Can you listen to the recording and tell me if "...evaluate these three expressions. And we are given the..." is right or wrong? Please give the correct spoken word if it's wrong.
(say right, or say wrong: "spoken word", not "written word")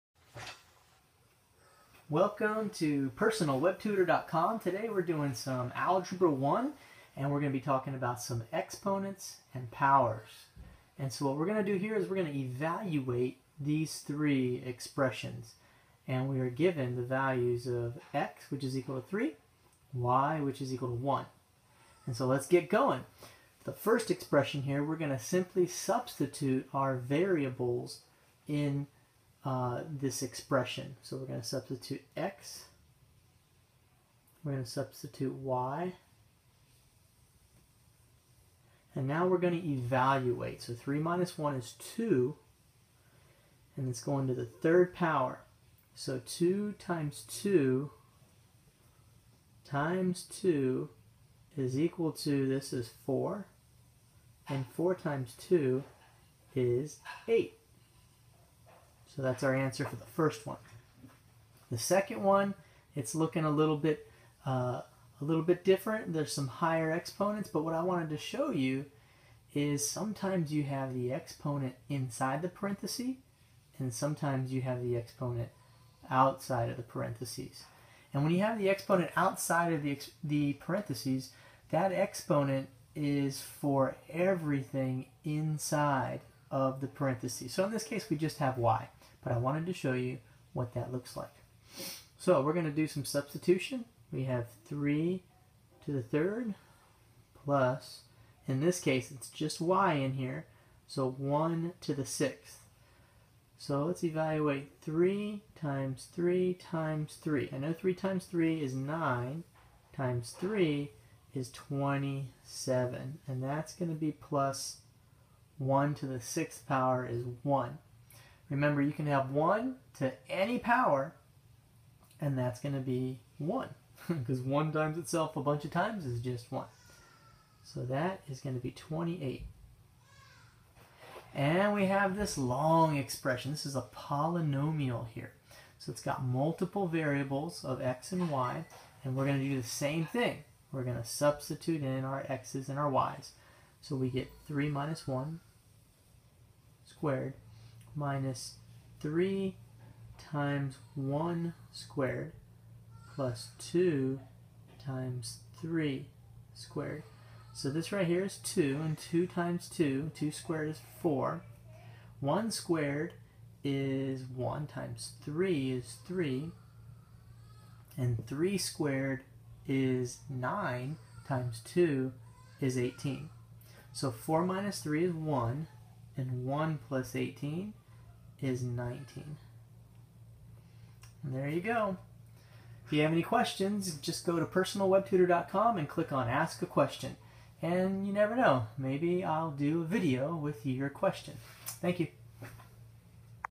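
right.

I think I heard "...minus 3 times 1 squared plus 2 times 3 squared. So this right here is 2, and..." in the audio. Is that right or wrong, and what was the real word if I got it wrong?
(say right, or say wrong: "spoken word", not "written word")
right.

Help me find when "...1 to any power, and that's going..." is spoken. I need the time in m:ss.
1:59.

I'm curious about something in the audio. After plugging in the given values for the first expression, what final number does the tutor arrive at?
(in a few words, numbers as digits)
8.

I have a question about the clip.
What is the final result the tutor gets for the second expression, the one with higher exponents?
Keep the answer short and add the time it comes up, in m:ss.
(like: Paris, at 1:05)
28, at 2:07.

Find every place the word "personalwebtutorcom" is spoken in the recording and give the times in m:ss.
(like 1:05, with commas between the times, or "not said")
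0:03, 3:04.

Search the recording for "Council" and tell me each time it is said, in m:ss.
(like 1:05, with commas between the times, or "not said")
not said.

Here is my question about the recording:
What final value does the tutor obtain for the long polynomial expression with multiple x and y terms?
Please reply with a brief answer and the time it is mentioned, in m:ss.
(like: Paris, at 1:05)
19, at 2:56.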